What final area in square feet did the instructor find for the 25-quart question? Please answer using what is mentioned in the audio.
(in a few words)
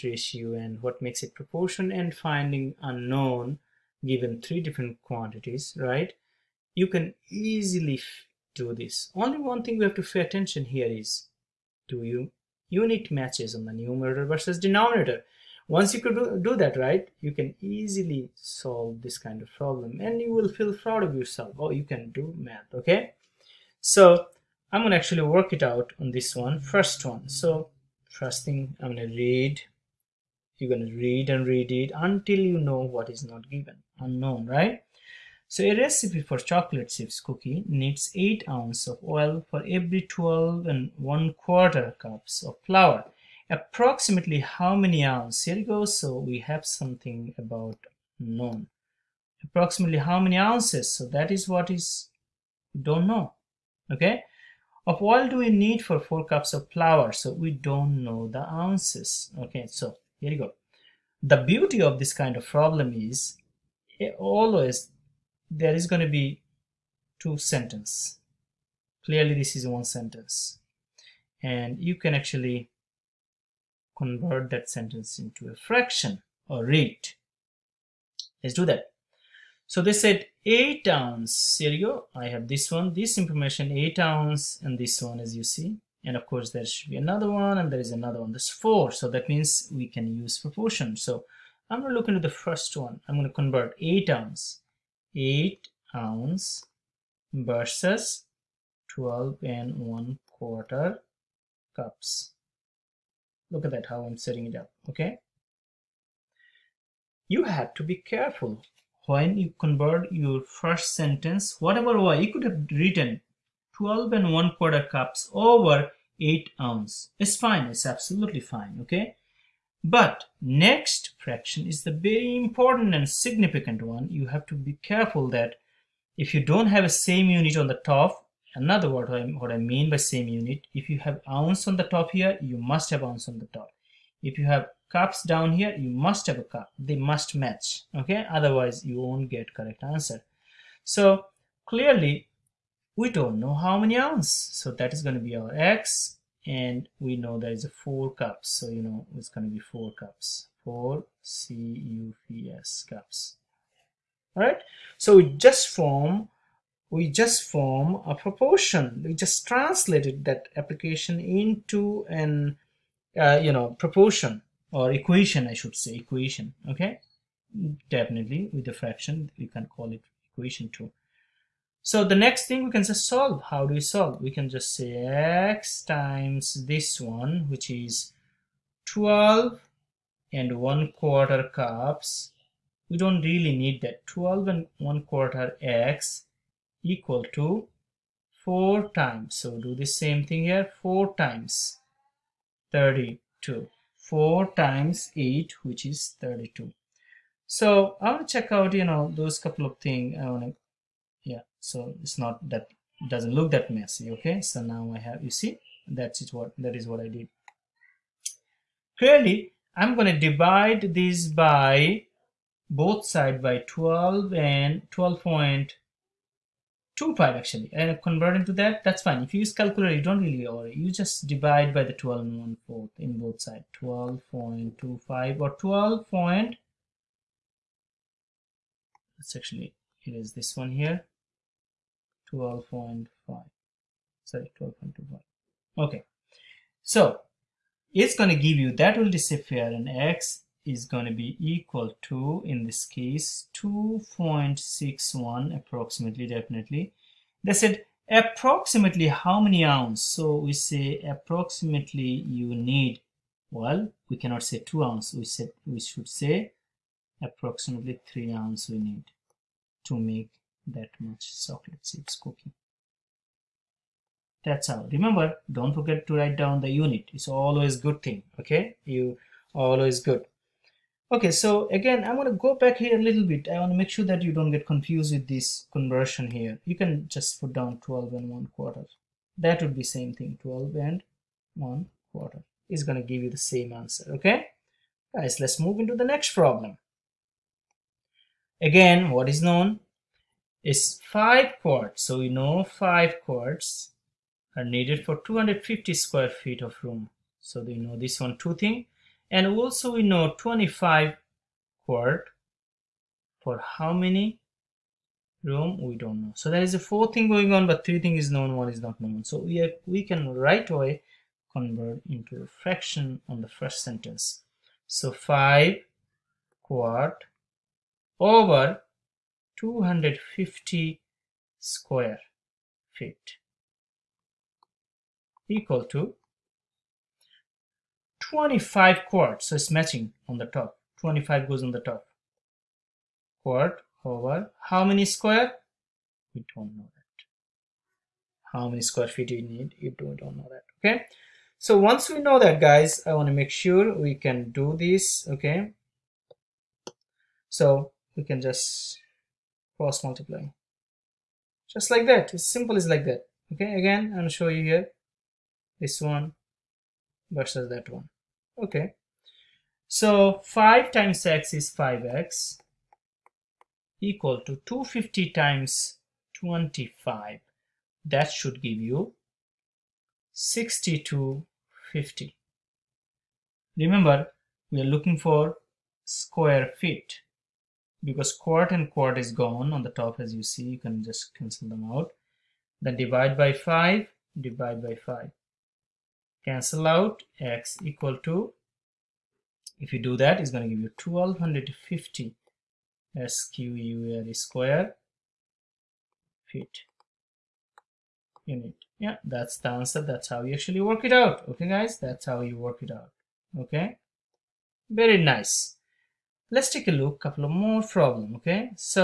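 1250 square feet.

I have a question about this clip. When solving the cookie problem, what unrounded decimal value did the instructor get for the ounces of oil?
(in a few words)
2.61.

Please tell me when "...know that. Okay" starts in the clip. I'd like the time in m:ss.
5:40.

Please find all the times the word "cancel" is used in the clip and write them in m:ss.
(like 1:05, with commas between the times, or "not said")
6:21, 6:26.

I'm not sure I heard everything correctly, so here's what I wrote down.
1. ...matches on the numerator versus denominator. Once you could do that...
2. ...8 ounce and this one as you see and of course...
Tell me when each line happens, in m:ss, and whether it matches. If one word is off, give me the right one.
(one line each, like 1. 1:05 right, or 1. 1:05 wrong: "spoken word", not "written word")
1. 0:13 right
2. 1:23 right.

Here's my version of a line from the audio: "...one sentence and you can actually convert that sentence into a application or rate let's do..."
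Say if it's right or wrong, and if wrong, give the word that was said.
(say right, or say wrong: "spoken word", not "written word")
wrong: "fraction", not "application".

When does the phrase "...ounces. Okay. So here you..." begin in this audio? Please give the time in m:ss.
0:58.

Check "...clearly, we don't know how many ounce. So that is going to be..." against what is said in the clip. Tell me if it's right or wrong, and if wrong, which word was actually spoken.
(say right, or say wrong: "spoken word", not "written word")
right.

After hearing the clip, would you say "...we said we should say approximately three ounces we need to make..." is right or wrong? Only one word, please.
right.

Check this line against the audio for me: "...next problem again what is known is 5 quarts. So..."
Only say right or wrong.
right.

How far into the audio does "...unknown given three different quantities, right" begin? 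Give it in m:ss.
0:02.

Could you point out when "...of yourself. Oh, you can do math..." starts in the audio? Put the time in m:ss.
0:21.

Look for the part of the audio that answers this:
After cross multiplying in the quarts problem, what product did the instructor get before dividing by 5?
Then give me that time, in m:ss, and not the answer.
6:10.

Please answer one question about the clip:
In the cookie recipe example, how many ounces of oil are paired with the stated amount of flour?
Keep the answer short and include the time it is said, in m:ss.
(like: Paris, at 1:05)
8 ounces, at 0:38.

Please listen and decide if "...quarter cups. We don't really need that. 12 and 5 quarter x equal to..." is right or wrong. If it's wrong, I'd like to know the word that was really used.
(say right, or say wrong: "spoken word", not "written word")
wrong: "1", not "5".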